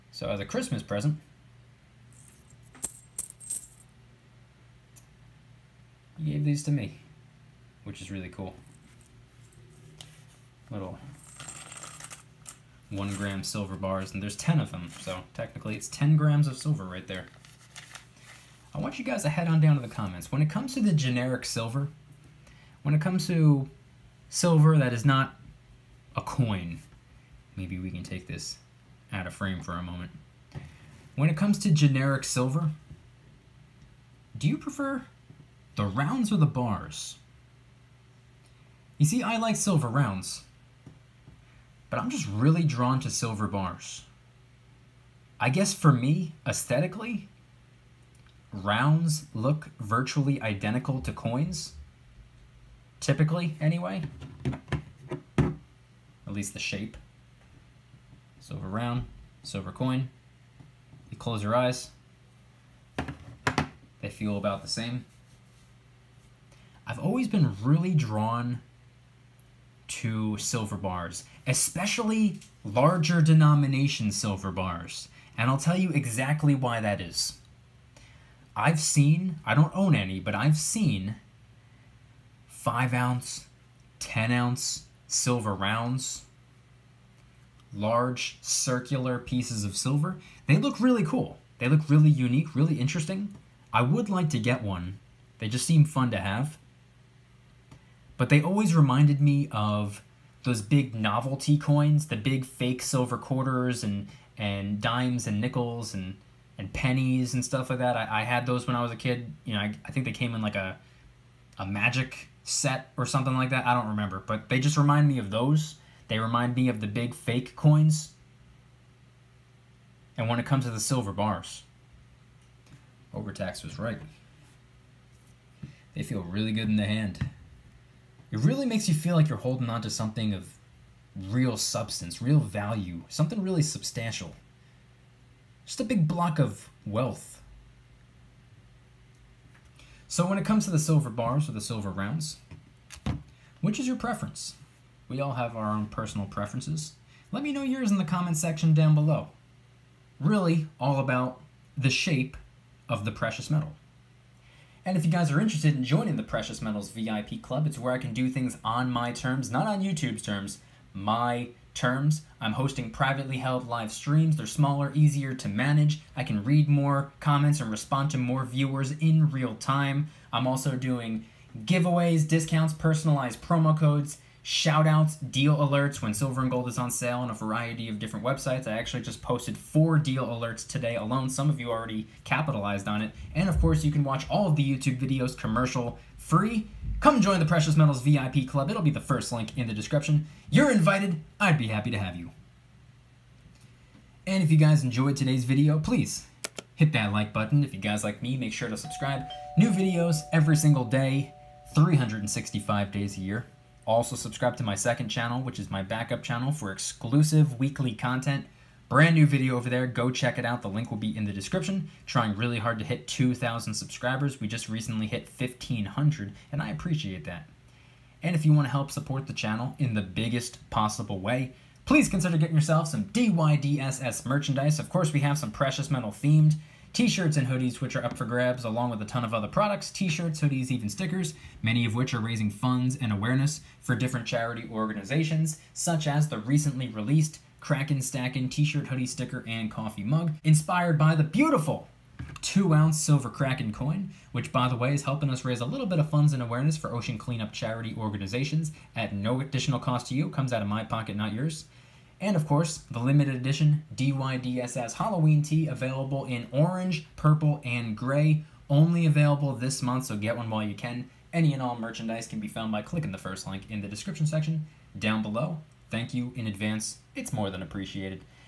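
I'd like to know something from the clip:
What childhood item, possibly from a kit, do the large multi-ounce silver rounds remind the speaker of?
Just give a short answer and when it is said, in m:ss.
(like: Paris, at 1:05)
magic set, at 1:51.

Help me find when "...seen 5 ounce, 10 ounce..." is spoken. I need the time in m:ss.
1:20.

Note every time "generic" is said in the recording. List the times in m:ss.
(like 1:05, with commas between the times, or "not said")
0:20, 0:31.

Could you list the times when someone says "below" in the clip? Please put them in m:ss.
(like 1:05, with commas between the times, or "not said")
2:28, 4:25.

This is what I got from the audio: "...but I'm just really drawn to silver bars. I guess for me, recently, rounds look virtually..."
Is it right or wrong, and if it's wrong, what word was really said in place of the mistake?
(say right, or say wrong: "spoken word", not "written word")
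wrong: "aesthetically", not "recently".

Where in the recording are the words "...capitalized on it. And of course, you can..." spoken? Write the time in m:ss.
3:02.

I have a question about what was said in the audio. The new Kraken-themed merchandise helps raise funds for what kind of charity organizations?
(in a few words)
ocean cleanup.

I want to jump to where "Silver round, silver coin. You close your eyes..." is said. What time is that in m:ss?
0:58.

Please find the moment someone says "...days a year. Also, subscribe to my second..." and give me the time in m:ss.
3:22.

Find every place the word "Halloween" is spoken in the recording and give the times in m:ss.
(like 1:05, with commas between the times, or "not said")
4:14.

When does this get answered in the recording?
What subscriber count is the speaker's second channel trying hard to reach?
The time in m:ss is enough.
3:33.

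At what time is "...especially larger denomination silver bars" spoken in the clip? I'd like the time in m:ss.
1:11.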